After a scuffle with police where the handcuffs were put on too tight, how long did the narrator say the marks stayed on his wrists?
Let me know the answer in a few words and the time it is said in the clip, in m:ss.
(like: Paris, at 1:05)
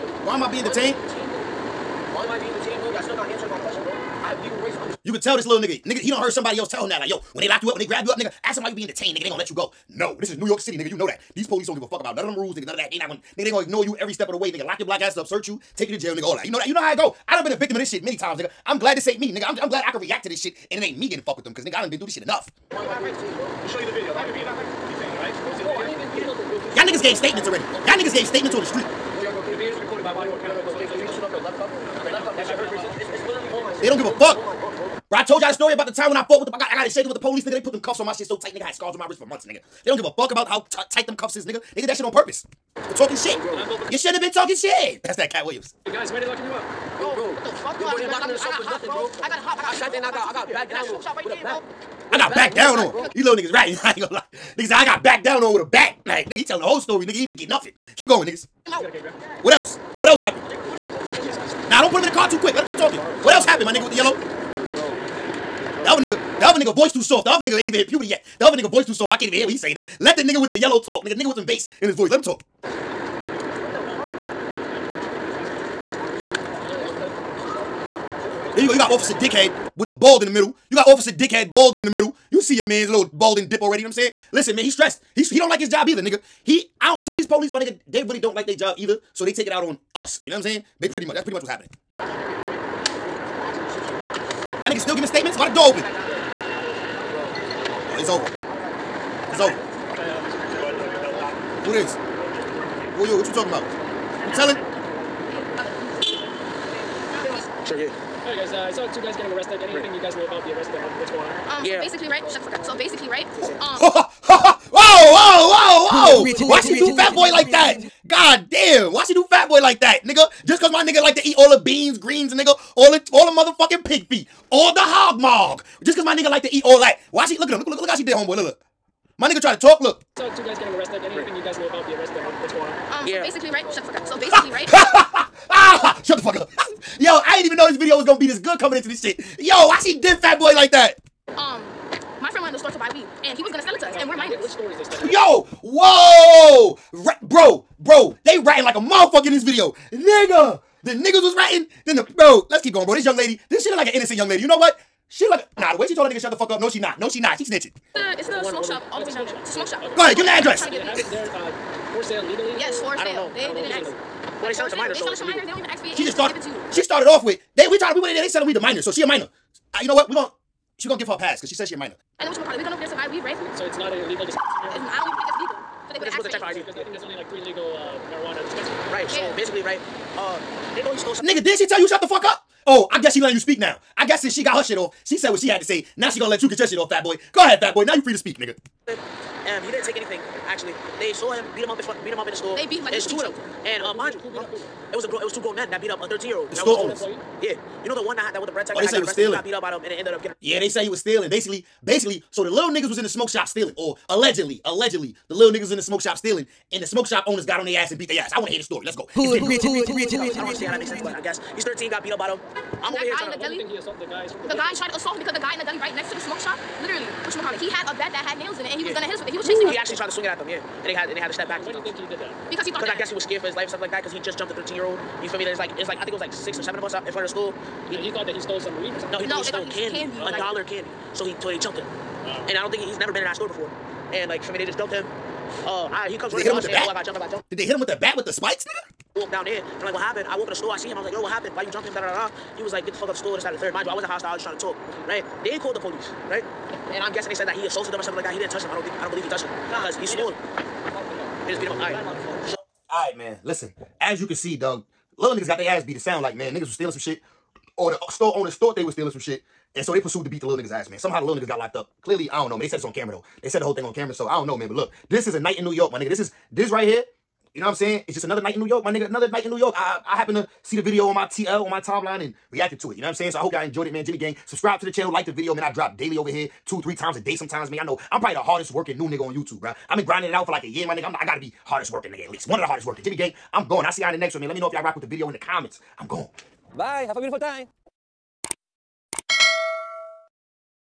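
months, at 0:39.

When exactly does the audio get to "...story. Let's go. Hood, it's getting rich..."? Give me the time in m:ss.
3:28.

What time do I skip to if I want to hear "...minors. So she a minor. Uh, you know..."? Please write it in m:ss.
2:48.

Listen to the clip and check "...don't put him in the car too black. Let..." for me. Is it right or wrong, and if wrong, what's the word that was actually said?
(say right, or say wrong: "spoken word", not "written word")
wrong: "quick", not "black".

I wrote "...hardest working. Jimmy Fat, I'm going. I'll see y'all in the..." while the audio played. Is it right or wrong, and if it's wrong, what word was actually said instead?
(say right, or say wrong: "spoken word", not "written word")
wrong: "Gang", not "Fat".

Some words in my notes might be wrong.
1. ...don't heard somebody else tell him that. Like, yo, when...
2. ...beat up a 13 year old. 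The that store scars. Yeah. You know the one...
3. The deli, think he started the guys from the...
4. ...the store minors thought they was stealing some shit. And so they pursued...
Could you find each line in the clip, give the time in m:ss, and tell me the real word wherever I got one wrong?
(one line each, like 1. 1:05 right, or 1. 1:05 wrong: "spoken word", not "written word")
1. 0:06 right
2. 3:15 wrong: "owners", not "scars"
3. 3:33 wrong: "assaulted", not "started"
4. 4:17 wrong: "owners", not "minors".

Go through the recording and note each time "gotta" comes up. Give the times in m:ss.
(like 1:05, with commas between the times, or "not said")
4:41.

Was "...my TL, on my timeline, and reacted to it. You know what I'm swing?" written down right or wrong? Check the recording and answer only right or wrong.
wrong.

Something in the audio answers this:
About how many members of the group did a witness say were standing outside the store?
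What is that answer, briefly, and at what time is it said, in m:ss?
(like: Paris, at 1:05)
6 or 7, at 3:46.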